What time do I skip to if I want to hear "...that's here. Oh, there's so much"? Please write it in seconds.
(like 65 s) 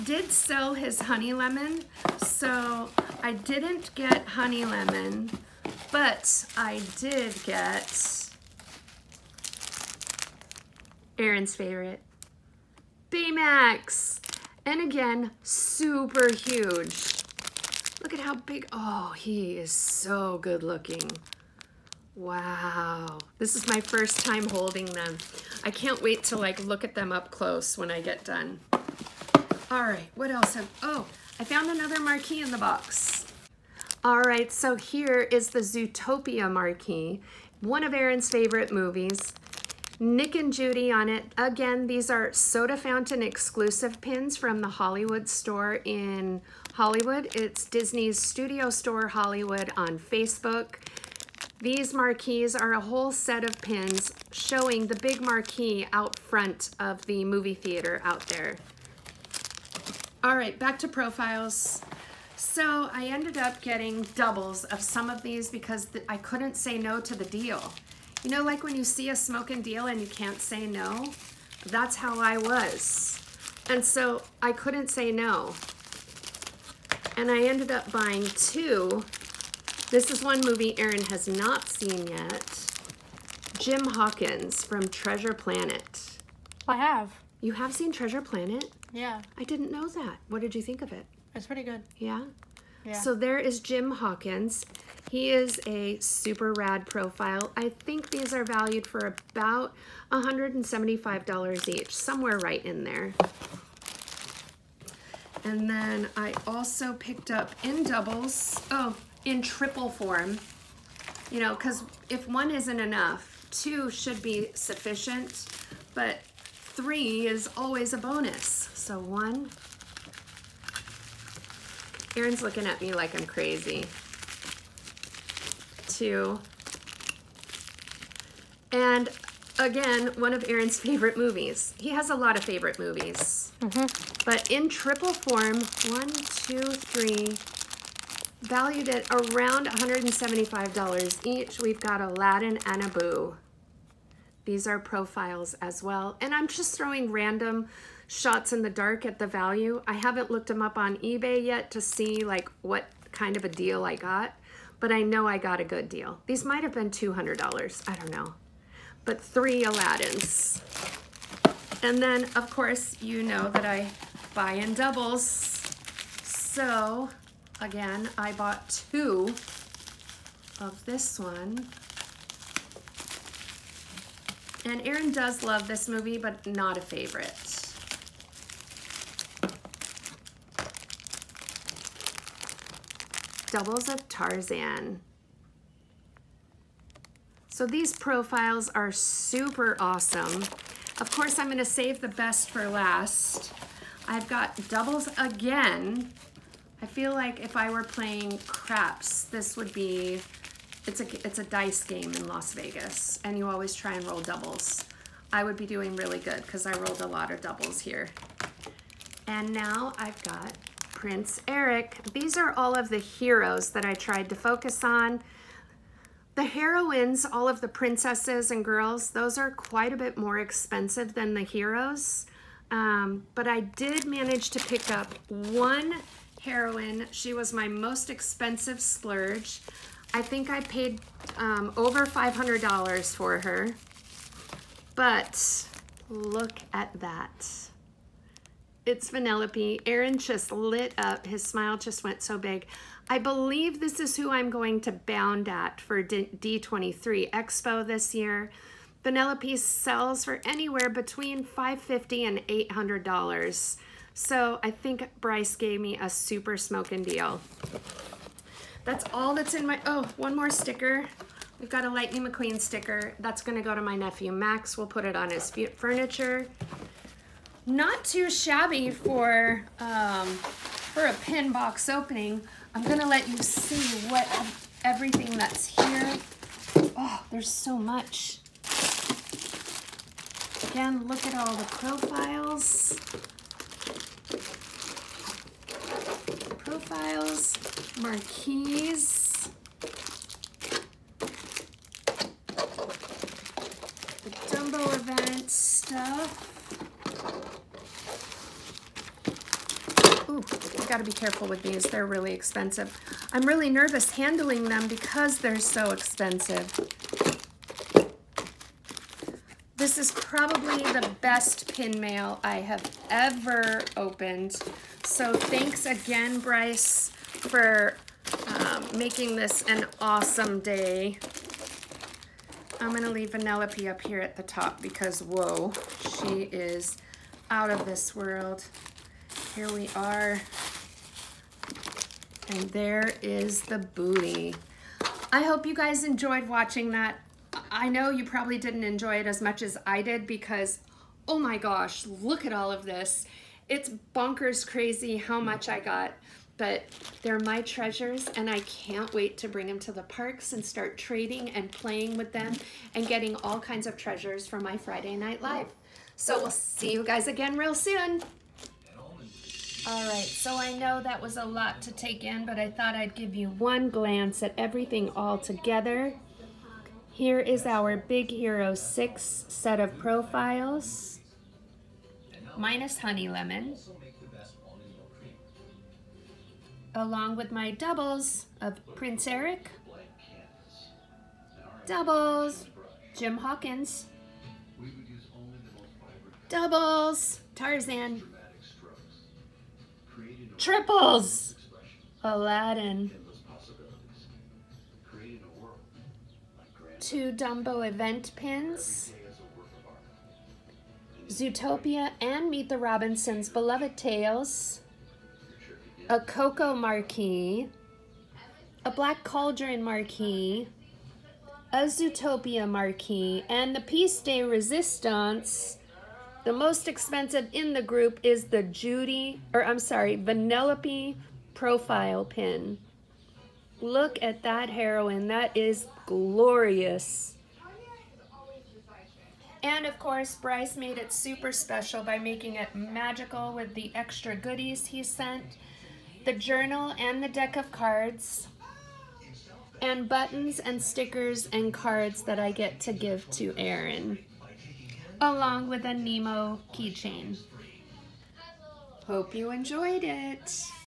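275 s.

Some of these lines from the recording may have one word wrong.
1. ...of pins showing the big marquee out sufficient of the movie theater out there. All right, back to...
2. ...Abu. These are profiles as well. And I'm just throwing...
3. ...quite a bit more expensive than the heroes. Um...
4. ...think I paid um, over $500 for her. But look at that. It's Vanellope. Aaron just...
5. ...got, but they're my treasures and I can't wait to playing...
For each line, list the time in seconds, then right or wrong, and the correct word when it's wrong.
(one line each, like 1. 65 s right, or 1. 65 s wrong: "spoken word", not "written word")
1. 53 s wrong: "front", not "sufficient"
2. 142 s right
3. 219 s right
4. 230 s right
5. 345 s wrong: "bring", not "playing".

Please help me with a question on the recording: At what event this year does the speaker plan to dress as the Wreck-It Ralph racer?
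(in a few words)
D23 Expo.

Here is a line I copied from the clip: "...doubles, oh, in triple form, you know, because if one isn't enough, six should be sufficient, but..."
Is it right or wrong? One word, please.
wrong.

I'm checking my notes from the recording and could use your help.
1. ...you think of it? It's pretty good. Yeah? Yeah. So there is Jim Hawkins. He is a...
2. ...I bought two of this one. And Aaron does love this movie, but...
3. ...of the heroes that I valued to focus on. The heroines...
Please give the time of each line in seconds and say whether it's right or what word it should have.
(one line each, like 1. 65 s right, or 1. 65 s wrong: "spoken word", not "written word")
1. 90 s right
2. 168 s right
3. 212 s wrong: "tried", not "valued".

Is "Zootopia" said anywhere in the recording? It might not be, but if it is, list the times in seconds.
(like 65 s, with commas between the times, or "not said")
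35 s, 401 s, 411 s.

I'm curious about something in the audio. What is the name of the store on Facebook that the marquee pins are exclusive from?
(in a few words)
Disney's Studio Store Hollywood.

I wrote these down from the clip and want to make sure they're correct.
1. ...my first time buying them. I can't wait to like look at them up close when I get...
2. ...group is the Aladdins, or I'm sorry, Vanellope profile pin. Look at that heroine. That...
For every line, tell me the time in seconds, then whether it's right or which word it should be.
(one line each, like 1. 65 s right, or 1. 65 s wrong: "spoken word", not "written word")
1. 23 s wrong: "holding", not "buying"
2. 417 s wrong: "Judy", not "Aladdins".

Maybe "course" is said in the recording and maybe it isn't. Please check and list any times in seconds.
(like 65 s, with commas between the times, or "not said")
162 s, 191 s, 429 s.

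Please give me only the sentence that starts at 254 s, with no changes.
So I think Bryce gave me a super smoking deal.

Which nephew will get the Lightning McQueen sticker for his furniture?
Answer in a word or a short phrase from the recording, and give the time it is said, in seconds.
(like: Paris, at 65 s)
Max, at 264 s.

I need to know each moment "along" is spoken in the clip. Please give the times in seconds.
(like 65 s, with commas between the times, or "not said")
376 s, 445 s.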